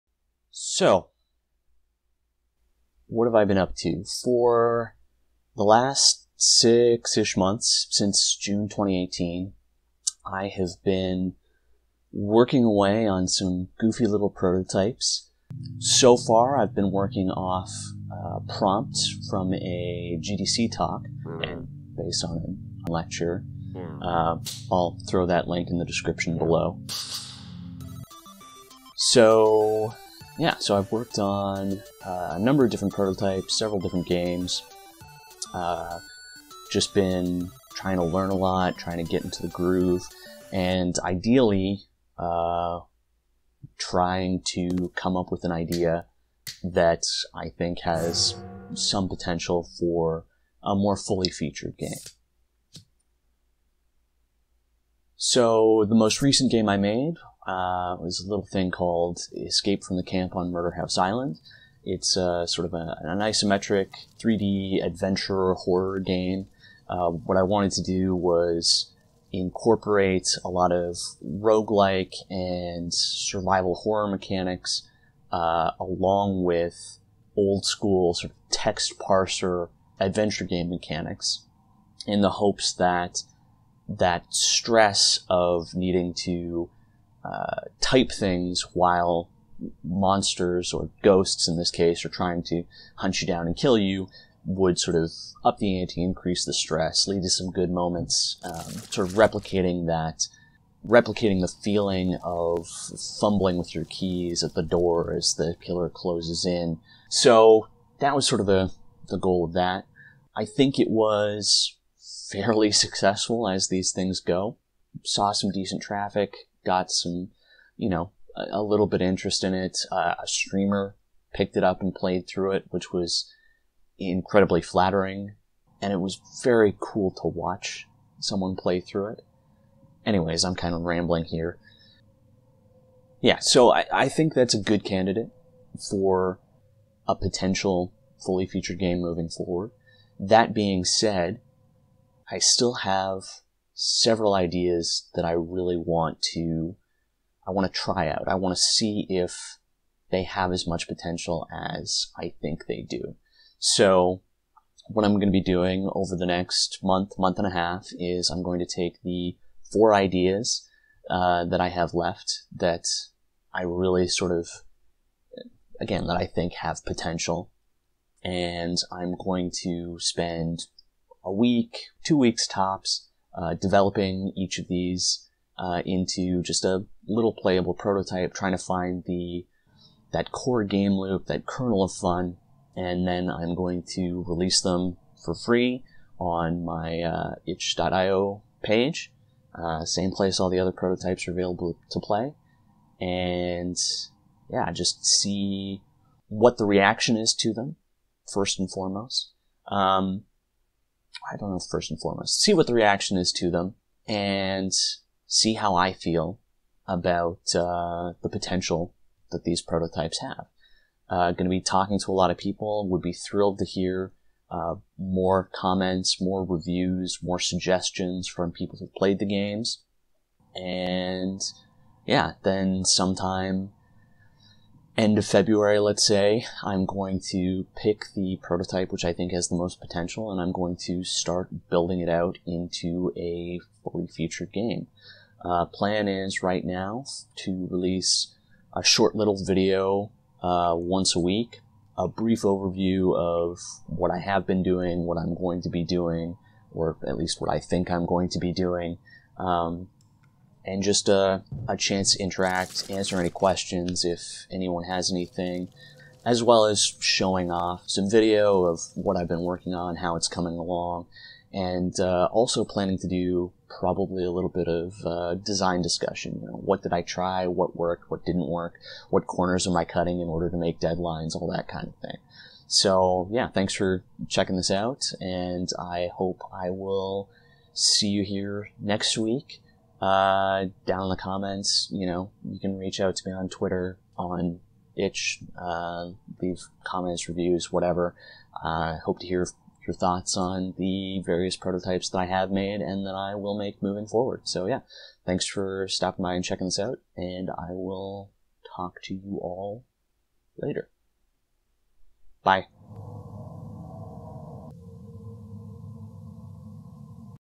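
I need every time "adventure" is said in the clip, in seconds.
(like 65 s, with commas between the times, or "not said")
64 s, 80 s.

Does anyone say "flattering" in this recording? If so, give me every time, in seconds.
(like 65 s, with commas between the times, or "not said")
124 s.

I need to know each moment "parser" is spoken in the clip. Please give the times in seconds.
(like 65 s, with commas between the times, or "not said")
78 s.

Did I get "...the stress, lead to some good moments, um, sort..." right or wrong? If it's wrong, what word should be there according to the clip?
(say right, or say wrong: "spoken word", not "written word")
right.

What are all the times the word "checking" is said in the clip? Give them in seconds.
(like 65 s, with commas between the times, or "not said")
274 s, 296 s.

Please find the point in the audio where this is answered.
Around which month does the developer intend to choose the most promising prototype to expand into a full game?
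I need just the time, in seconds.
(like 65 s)
225 s.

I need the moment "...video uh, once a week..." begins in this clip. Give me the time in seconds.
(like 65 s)
239 s.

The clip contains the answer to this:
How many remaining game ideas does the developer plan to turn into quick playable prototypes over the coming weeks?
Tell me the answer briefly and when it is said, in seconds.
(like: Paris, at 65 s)
4, at 159 s.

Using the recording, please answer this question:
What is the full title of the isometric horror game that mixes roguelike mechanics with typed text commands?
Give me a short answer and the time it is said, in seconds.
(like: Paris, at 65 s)
Escape from the Camp on Murderhaus Island, at 59 s.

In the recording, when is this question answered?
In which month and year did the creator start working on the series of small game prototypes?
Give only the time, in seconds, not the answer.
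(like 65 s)
8 s.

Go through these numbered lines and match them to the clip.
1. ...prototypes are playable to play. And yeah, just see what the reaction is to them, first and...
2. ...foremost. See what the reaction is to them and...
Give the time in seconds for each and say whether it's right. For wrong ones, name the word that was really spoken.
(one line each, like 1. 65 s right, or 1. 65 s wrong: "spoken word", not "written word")
1. 190 s wrong: "available", not "playable"
2. 201 s right.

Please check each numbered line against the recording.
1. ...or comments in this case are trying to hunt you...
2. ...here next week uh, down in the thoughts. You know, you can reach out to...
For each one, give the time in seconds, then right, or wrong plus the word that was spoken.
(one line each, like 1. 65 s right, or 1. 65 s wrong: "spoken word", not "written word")
1. 90 s wrong: "ghosts", not "comments"
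2. 278 s wrong: "comments", not "thoughts".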